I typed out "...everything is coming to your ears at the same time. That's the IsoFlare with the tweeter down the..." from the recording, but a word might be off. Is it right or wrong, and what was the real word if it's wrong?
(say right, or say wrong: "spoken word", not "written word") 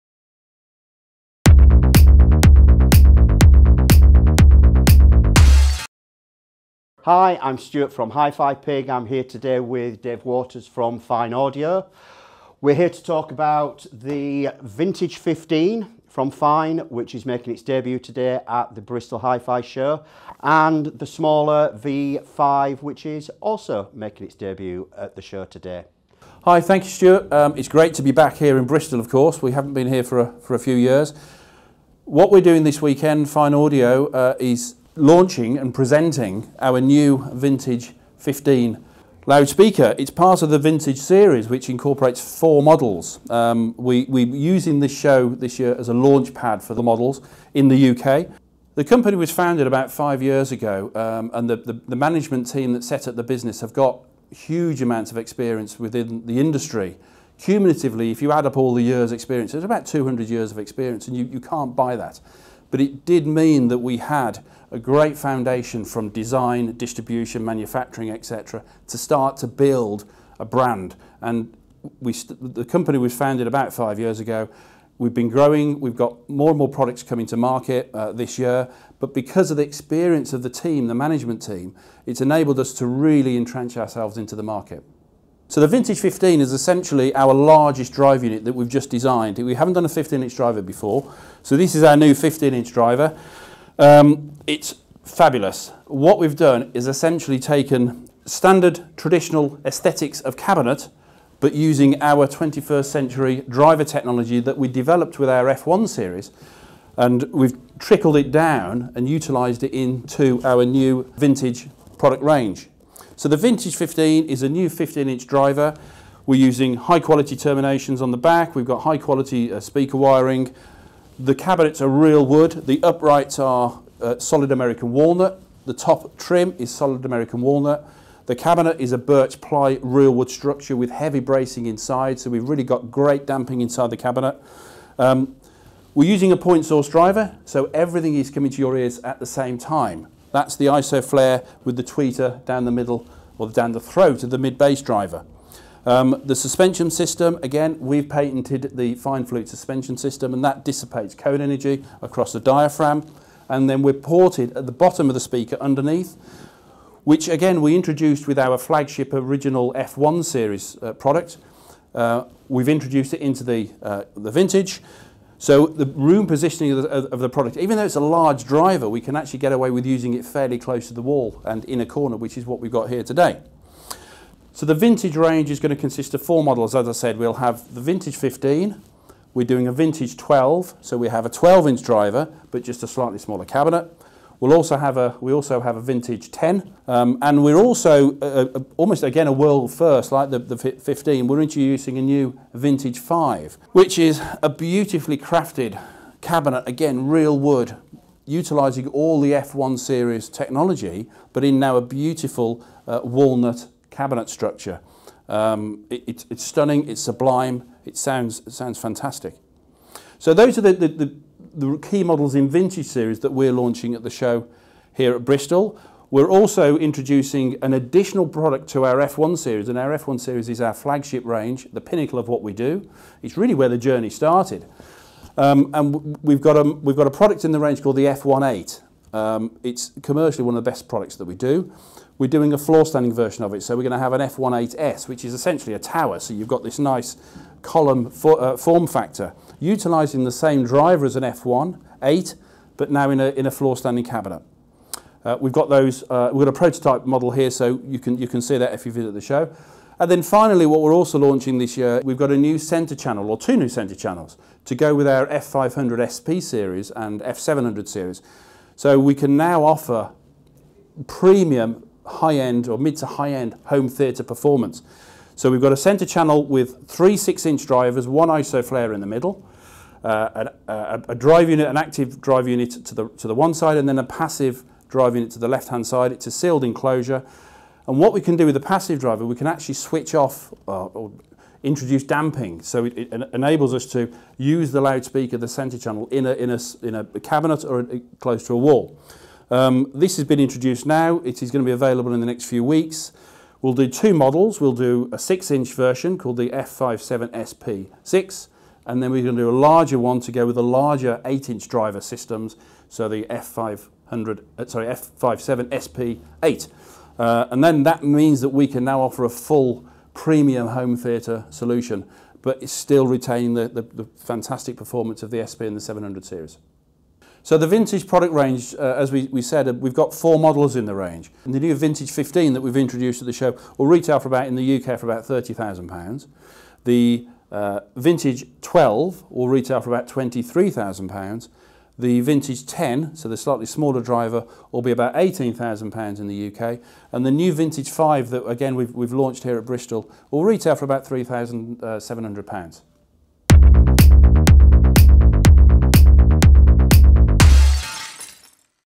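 right.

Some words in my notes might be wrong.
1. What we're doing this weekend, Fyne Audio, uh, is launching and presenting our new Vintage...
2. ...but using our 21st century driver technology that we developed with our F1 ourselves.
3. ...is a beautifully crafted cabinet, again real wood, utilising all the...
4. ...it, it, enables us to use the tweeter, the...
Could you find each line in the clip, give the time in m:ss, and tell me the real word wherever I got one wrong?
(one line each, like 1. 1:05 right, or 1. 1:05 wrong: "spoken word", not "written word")
1. 0:32 right
2. 1:41 wrong: "series", not "ourselves"
3. 3:13 right
4. 4:42 wrong: "loudspeaker", not "tweeter".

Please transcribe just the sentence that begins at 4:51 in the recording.
It is going to be available in the next few weeks.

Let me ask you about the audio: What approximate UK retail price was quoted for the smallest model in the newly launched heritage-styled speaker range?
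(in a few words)
£3,700.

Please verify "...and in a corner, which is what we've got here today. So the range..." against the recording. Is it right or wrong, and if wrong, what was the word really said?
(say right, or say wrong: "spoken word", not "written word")
wrong: "vintage", not "range".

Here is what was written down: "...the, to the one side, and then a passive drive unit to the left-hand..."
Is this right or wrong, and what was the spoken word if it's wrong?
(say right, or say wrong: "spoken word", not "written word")
right.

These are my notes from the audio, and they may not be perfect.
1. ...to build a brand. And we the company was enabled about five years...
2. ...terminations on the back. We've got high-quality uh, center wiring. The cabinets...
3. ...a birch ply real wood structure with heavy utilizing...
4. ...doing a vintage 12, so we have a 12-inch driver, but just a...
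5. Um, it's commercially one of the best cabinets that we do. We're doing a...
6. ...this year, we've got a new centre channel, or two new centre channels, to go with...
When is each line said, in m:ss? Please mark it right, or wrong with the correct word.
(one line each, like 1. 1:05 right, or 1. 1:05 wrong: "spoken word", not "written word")
1. 1:09 wrong: "founded", not "enabled"
2. 1:57 wrong: "speaker", not "center"
3. 2:08 wrong: "bracing", not "utilizing"
4. 2:59 right
5. 3:49 wrong: "products", not "cabinets"
6. 4:11 right.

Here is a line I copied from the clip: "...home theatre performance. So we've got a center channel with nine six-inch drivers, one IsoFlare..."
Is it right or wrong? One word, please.
wrong.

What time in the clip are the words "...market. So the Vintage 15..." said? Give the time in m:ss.
1:24.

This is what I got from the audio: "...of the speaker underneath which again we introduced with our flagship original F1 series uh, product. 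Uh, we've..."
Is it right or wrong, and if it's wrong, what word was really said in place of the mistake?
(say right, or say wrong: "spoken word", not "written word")
right.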